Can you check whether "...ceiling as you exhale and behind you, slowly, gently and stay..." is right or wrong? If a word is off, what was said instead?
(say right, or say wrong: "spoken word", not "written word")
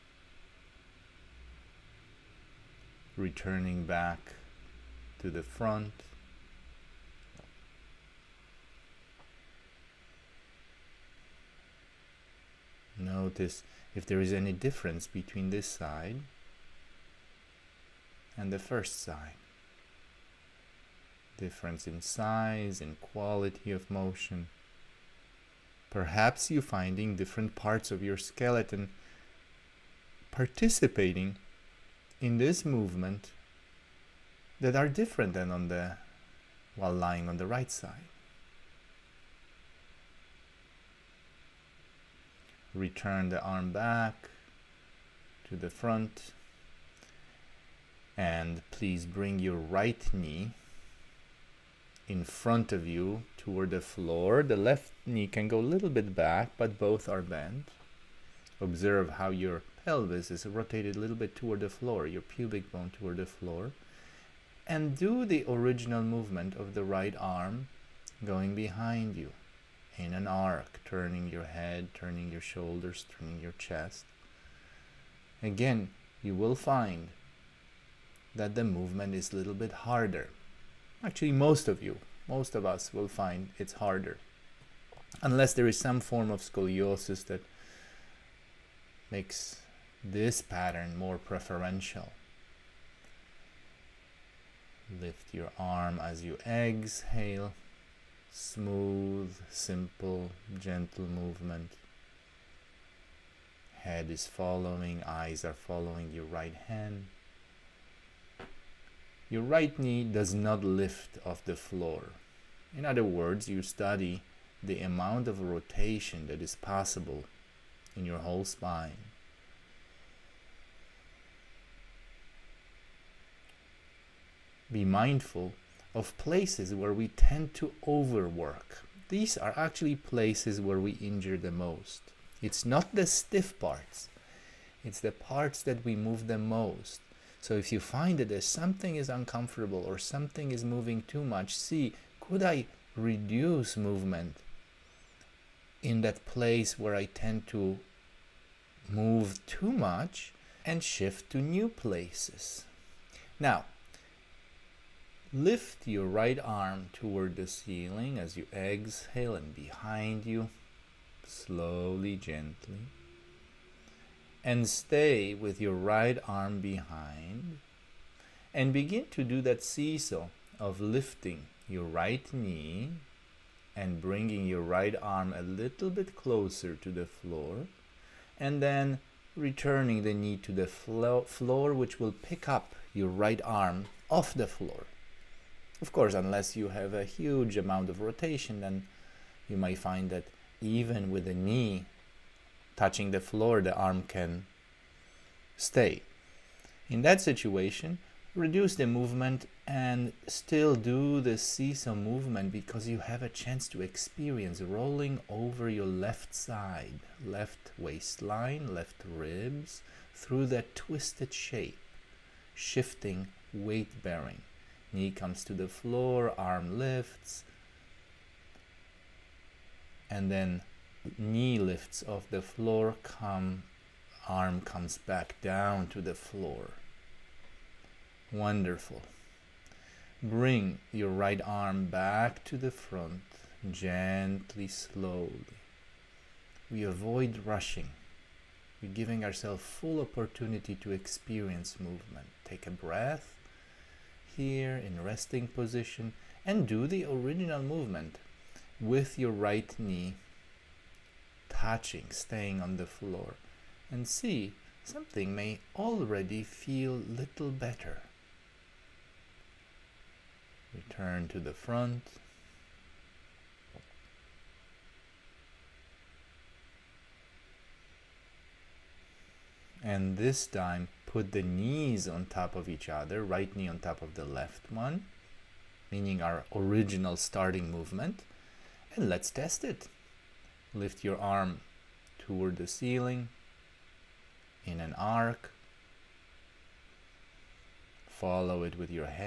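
right.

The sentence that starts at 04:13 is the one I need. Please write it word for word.
And see, something may already feel little better.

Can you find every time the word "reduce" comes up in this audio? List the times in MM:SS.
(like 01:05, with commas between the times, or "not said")
02:22, 03:18.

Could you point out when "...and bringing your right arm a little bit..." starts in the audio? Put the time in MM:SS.
02:53.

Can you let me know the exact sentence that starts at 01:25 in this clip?
Unless there is some form of scoliosis that makes this pattern more preferential.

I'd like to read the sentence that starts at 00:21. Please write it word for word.
Difference in size, in quality of motion.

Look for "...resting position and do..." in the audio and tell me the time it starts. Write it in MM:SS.
04:05.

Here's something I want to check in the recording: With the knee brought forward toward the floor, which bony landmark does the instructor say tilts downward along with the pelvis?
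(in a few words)
Pubic bone.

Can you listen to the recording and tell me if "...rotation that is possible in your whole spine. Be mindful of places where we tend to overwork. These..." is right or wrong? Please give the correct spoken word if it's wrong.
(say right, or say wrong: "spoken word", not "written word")
right.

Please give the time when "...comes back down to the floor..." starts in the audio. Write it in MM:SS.
03:44.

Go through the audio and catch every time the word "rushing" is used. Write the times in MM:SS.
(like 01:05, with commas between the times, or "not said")
03:57.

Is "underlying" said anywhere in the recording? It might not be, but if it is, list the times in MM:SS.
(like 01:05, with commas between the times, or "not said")
not said.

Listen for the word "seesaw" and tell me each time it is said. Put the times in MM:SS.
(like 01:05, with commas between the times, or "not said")
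02:49, 03:21.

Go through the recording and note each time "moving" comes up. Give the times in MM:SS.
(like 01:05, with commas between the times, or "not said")
02:20.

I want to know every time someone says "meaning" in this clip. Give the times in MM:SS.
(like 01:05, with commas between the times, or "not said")
04:35.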